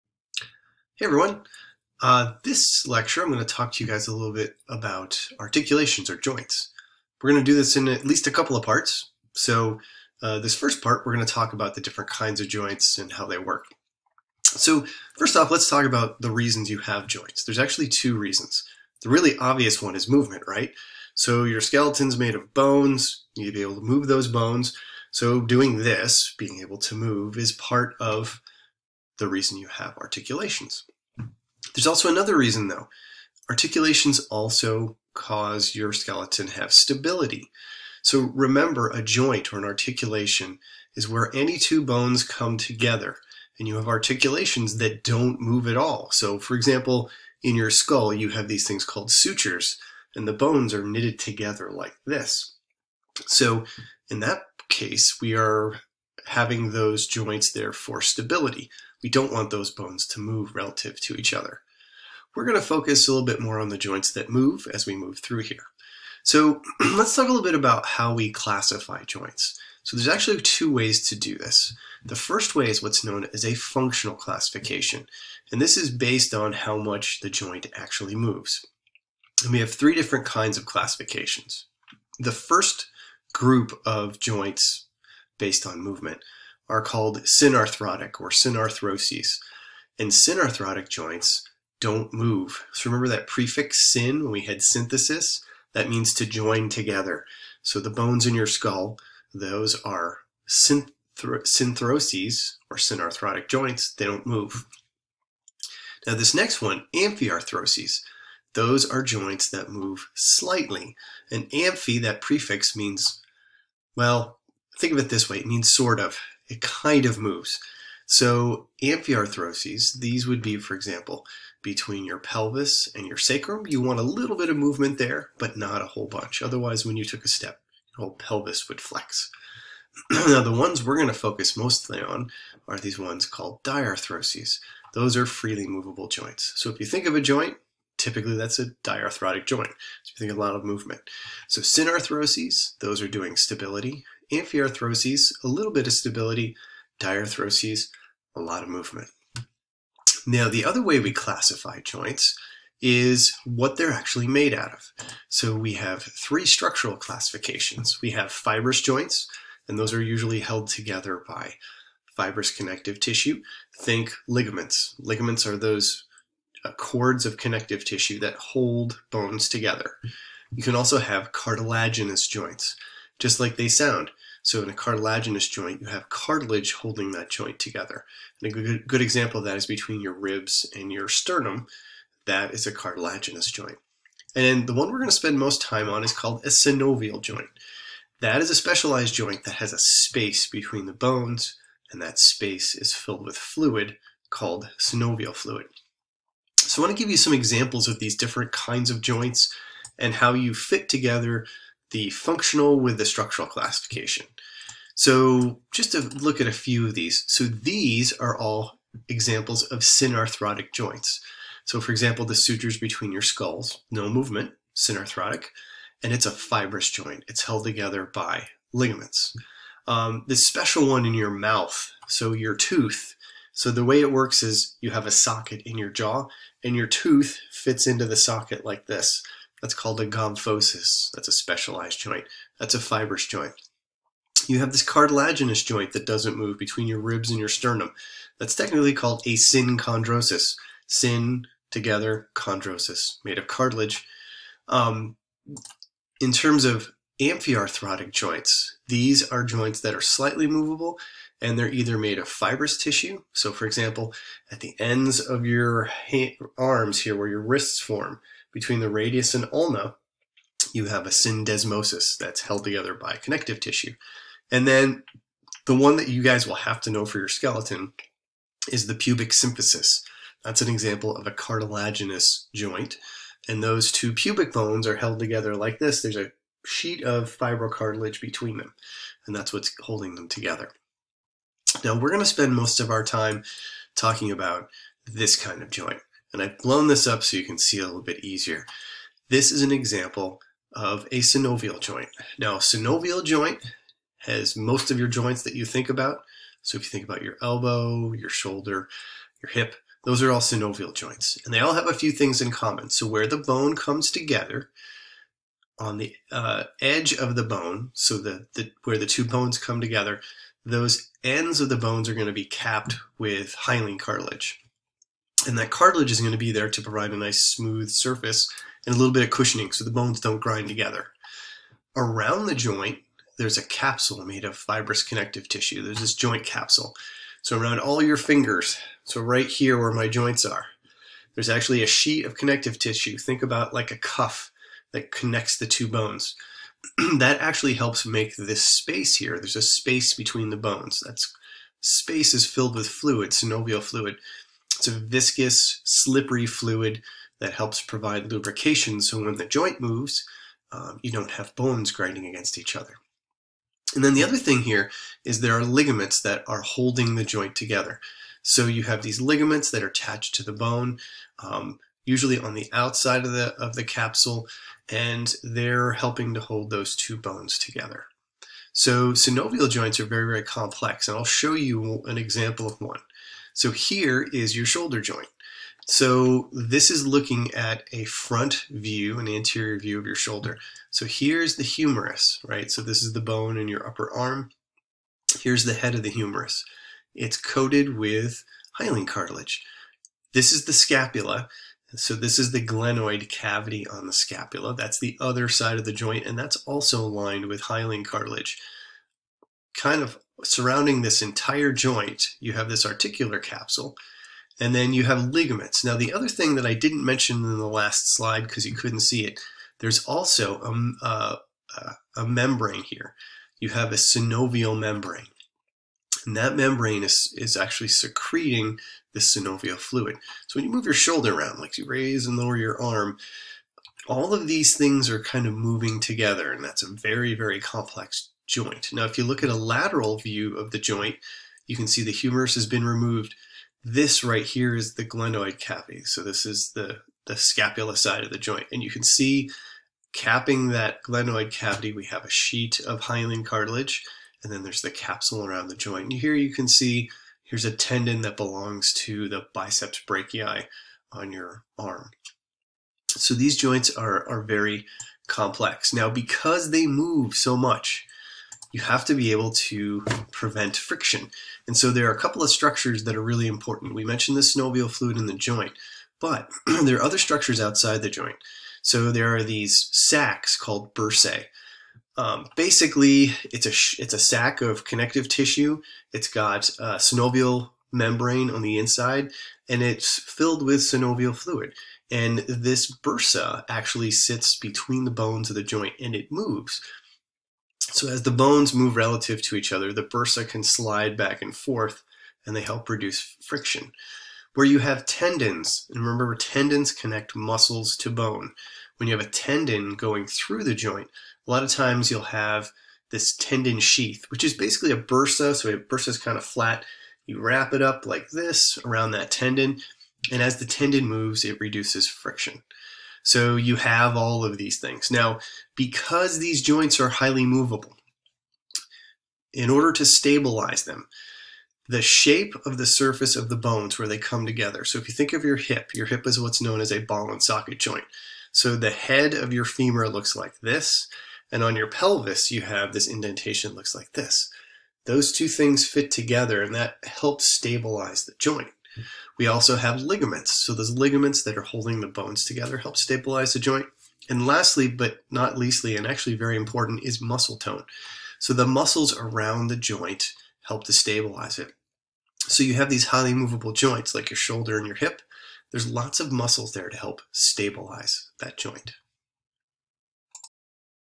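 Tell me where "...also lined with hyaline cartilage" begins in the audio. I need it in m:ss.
6:36.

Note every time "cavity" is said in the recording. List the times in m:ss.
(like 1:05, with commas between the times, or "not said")
6:33, 7:15, 7:21.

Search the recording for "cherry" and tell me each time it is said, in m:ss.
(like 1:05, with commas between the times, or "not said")
not said.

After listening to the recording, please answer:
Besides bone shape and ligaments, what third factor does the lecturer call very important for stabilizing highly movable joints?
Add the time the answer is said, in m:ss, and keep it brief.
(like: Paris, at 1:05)
muscle tone, at 9:07.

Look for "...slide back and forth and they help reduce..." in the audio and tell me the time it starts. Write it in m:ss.
8:10.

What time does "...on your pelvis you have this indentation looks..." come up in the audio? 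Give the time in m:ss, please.
8:51.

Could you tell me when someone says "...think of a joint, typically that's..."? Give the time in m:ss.
2:16.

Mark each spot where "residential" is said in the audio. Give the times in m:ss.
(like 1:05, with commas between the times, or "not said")
not said.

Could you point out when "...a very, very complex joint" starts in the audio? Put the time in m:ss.
7:06.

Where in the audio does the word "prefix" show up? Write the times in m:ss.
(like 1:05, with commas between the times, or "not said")
1:33, 1:52.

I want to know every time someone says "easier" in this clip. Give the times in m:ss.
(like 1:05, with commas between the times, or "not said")
4:48.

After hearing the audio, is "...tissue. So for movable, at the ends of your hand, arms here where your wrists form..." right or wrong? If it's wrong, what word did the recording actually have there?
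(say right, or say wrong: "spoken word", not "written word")
wrong: "example", not "movable".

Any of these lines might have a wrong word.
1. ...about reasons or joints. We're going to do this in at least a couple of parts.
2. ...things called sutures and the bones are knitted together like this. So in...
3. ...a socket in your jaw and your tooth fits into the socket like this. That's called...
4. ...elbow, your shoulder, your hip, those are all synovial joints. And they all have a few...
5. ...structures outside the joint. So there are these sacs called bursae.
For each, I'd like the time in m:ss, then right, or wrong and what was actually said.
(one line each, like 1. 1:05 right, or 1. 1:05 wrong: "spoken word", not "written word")
1. 0:04 wrong: "articulations", not "reasons"
2. 0:48 right
3. 3:45 right
4. 4:57 right
5. 7:47 right.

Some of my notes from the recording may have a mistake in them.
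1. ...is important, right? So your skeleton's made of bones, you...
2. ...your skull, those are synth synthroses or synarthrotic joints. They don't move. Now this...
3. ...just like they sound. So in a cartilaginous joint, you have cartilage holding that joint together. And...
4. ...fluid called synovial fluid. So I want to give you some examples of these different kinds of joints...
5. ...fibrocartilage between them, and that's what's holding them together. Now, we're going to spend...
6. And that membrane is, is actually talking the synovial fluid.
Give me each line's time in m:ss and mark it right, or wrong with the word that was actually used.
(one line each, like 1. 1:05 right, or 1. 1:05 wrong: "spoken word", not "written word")
1. 0:19 wrong: "movement", not "important"
2. 1:38 right
3. 2:53 right
4. 3:13 right
5. 4:37 right
6. 6:56 wrong: "secreting", not "talking".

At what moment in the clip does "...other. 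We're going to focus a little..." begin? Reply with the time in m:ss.
1:01.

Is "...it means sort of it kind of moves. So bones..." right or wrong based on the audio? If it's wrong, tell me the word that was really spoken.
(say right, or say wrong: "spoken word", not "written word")
wrong: "amphiarthroses", not "bones".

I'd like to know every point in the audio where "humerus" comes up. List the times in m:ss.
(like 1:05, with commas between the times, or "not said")
6:21, 6:26, 7:12.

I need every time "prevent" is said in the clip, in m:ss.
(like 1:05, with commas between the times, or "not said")
7:40.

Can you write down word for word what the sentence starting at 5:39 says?
There's a space between the bones.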